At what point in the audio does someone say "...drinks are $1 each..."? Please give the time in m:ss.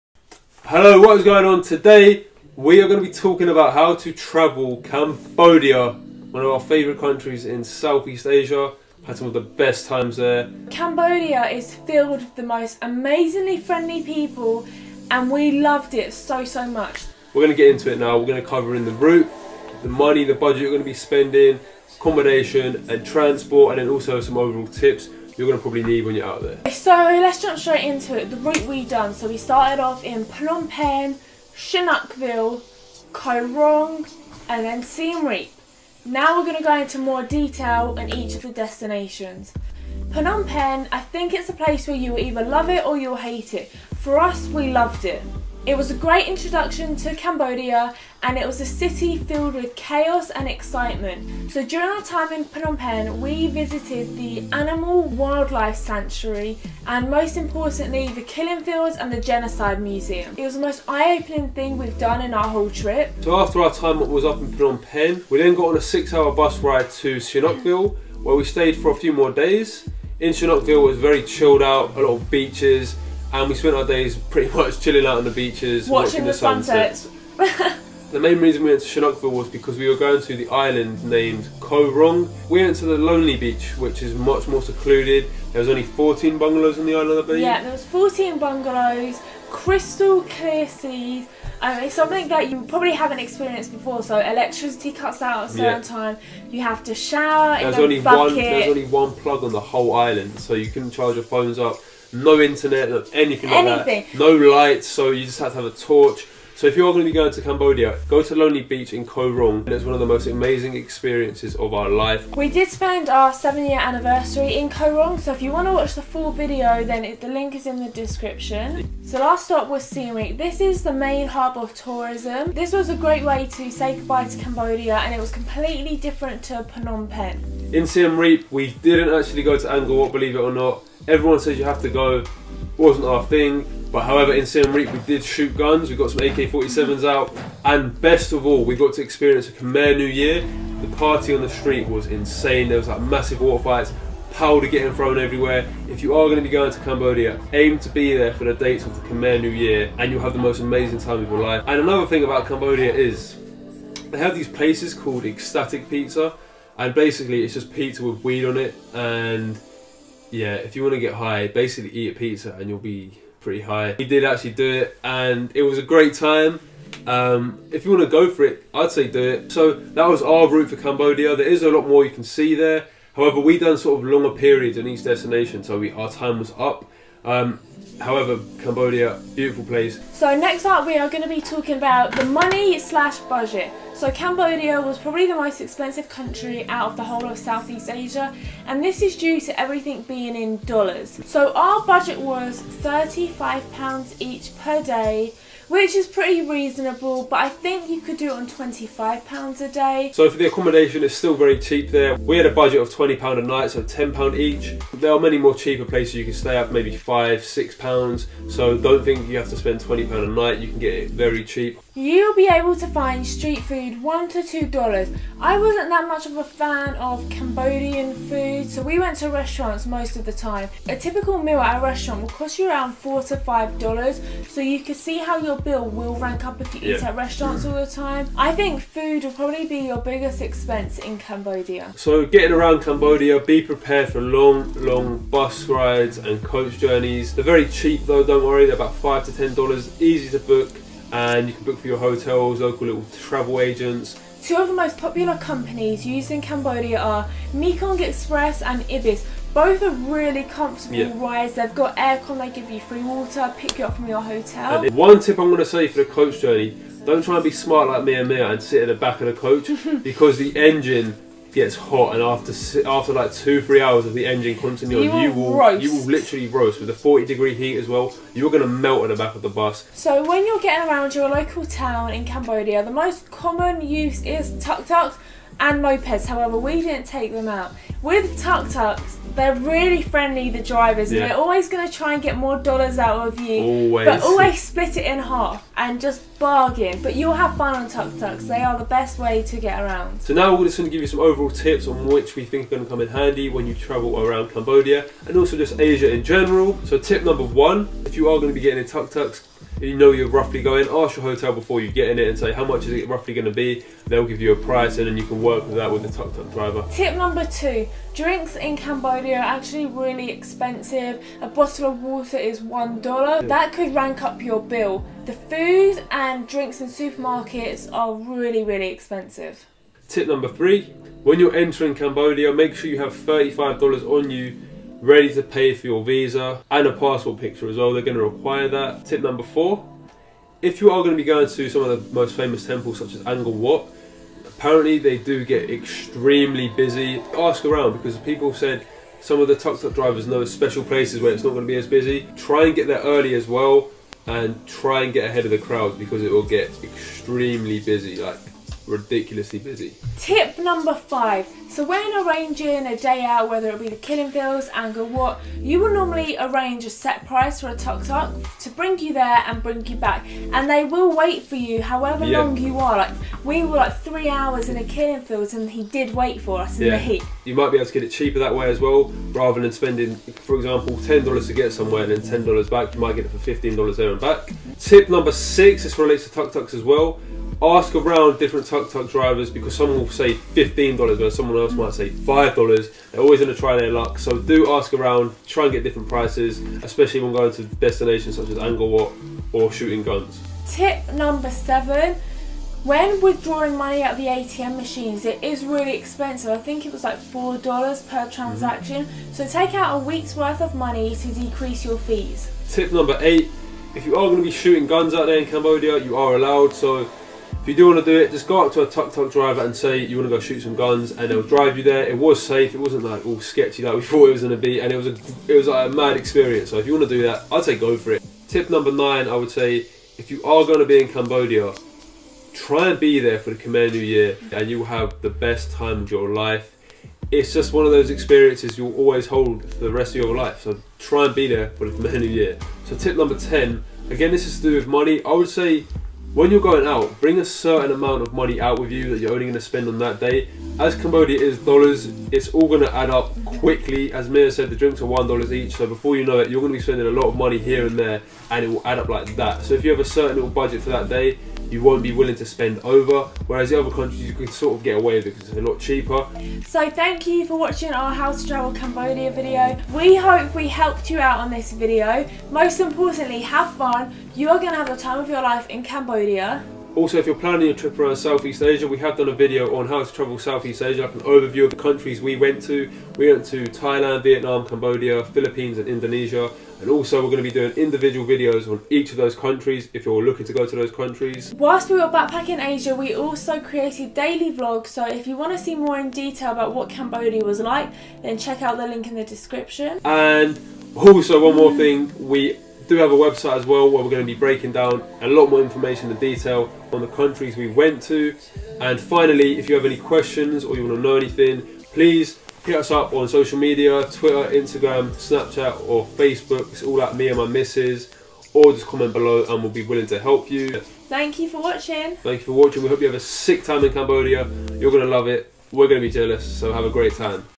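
7:24.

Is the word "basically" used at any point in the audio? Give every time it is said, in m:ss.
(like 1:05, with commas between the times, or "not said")
2:36, 2:41.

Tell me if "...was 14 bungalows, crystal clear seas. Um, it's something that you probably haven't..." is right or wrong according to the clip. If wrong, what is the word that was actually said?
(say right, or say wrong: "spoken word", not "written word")
right.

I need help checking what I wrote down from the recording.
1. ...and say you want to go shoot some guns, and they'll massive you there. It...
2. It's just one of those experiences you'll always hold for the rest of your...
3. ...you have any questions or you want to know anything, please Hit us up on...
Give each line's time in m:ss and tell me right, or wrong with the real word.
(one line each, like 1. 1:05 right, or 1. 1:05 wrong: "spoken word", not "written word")
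1. 6:49 wrong: "drive", not "massive"
2. 7:07 right
3. 8:19 right.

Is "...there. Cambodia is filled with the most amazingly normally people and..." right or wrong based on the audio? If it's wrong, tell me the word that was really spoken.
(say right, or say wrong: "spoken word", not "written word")
wrong: "friendly", not "normally".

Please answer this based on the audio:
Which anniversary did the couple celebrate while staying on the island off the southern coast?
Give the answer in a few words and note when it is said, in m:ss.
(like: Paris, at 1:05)
seven year anniversary, at 1:53.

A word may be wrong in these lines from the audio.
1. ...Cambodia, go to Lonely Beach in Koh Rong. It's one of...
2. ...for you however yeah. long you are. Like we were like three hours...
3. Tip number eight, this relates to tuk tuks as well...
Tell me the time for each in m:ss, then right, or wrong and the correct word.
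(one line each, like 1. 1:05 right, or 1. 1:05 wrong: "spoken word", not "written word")
1. 1:47 right
2. 6:01 right
3. 6:14 wrong: "six", not "eight".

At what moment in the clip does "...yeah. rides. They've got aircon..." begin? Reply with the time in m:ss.
4:10.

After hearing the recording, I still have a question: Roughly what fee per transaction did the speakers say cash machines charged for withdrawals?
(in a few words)
$4.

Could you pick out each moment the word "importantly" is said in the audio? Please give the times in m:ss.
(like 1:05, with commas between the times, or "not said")
0:57, 7:42.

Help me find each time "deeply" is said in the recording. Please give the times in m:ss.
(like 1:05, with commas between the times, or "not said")
not said.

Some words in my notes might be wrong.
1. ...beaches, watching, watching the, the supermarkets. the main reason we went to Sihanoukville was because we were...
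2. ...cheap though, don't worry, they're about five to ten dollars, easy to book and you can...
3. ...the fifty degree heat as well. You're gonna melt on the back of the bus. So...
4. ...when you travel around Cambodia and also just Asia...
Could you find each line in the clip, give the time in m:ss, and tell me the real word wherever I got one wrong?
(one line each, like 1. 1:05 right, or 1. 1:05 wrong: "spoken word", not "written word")
1. 1:15 wrong: "sunsets", not "supermarkets"
2. 3:57 right
3. 4:26 wrong: "forty", not "fifty"
4. 4:53 right.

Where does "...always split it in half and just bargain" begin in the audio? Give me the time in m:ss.
4:44.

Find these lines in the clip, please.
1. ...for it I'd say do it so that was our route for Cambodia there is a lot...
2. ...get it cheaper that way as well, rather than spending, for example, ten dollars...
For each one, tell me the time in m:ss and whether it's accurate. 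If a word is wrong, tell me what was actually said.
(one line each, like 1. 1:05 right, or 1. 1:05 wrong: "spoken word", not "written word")
1. 2:48 right
2. 6:07 right.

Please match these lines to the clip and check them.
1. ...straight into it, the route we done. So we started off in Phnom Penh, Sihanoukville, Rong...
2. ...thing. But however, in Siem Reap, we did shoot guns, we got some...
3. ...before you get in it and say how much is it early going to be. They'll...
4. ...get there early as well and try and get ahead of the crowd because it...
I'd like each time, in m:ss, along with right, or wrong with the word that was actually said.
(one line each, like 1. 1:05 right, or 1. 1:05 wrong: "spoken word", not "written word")
1. 0:27 right
2. 2:13 right
3. 5:01 wrong: "roughly", not "early"
4. 5:42 right.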